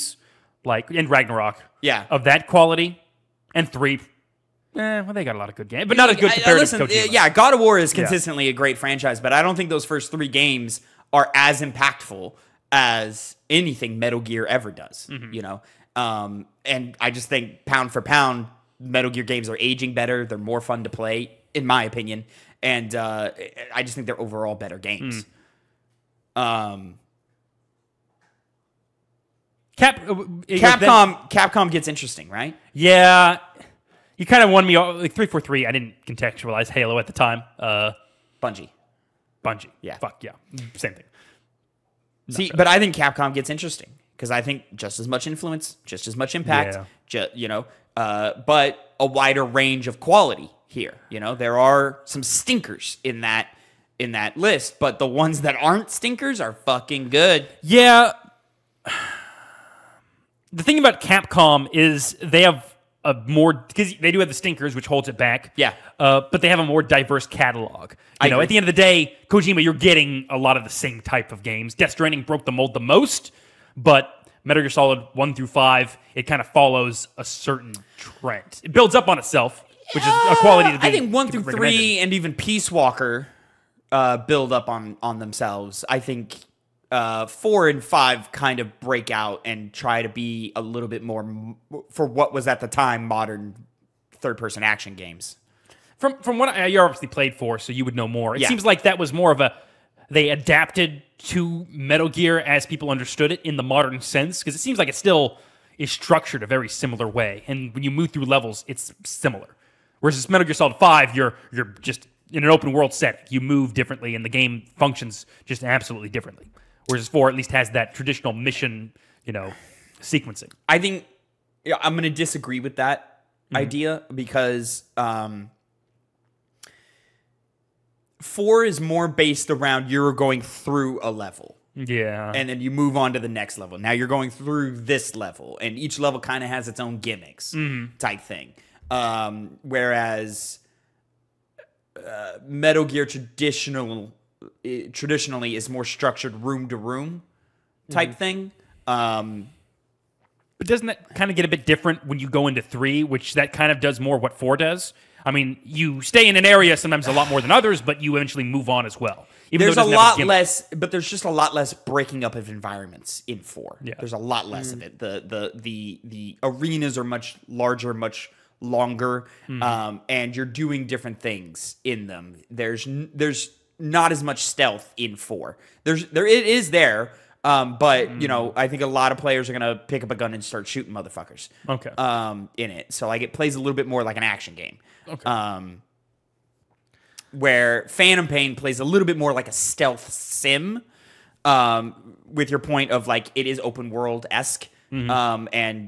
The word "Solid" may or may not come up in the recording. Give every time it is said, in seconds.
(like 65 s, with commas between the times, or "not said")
74 s, 110 s.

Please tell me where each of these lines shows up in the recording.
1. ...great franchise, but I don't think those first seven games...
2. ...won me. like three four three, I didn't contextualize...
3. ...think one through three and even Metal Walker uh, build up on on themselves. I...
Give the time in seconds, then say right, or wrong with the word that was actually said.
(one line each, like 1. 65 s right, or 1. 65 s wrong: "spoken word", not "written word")
1. 8 s wrong: "three", not "seven"
2. 34 s right
3. 80 s wrong: "Peace", not "Metal".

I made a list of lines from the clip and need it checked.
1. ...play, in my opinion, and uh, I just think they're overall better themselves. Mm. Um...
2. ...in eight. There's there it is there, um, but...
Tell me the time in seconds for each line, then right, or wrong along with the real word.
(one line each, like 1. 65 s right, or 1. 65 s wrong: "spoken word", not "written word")
1. 20 s wrong: "games", not "themselves"
2. 174 s wrong: "four", not "eight".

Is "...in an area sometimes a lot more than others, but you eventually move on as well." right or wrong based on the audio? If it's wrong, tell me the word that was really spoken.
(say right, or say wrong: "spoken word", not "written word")
right.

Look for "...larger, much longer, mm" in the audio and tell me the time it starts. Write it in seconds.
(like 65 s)
167 s.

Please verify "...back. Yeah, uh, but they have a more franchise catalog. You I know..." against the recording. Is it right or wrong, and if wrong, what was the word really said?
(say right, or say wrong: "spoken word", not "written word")
wrong: "diverse", not "franchise".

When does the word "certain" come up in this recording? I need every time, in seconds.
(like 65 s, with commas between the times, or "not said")
77 s.